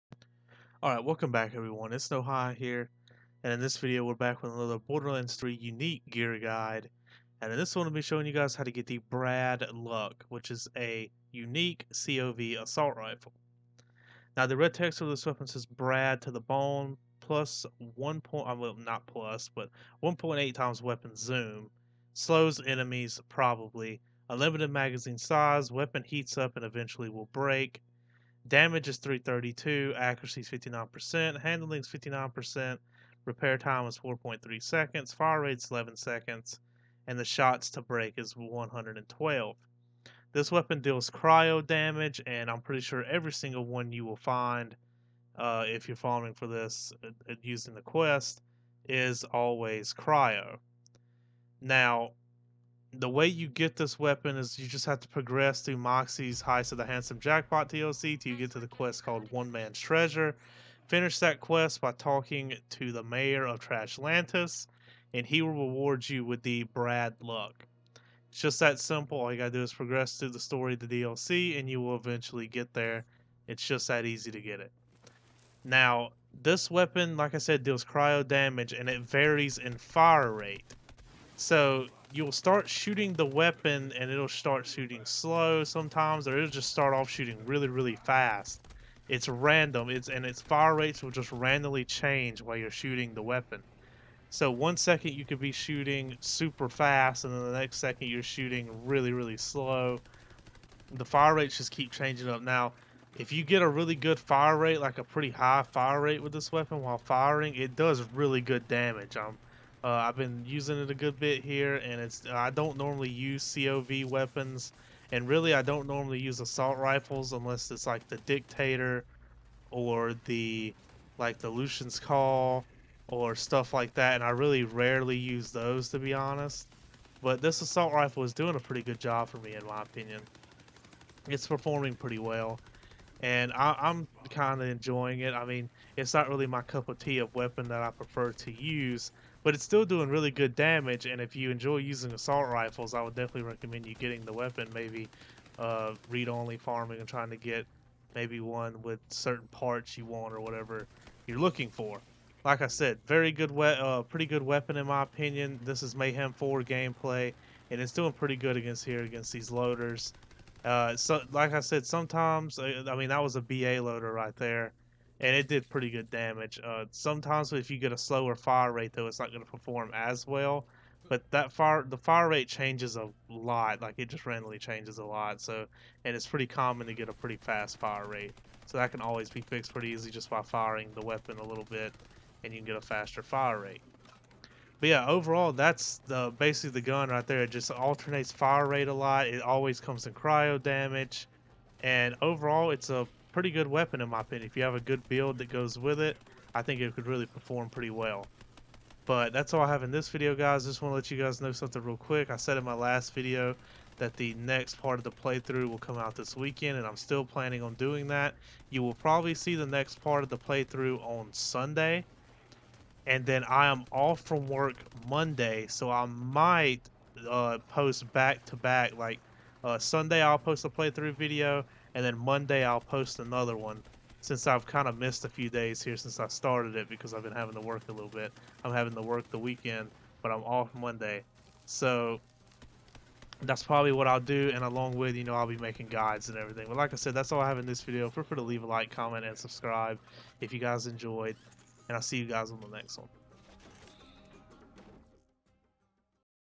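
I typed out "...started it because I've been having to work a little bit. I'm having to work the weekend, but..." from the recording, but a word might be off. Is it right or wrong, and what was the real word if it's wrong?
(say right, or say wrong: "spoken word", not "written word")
right.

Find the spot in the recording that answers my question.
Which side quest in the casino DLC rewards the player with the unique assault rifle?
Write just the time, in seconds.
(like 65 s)
59 s.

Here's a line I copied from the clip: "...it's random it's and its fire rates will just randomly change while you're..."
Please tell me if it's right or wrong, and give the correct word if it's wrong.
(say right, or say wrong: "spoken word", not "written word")
right.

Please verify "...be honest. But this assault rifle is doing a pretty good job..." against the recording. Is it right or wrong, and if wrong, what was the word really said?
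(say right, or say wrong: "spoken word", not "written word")
right.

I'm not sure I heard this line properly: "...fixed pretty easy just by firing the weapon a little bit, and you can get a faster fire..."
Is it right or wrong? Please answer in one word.
right.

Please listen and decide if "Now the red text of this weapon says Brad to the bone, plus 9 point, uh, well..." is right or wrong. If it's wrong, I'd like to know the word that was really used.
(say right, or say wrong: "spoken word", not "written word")
wrong: "1", not "9".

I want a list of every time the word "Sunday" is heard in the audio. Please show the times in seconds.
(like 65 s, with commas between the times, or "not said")
211 s, 219 s.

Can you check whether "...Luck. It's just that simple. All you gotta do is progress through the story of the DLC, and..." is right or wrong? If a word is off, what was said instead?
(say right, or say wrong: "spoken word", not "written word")
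right.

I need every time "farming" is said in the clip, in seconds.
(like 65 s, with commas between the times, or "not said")
45 s, 146 s.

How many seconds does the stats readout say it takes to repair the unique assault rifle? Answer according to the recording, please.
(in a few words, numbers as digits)
4.3 seconds.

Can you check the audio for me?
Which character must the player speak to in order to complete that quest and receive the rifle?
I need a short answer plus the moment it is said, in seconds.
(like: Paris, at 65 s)
the mayor of Trashlantis, at 62 s.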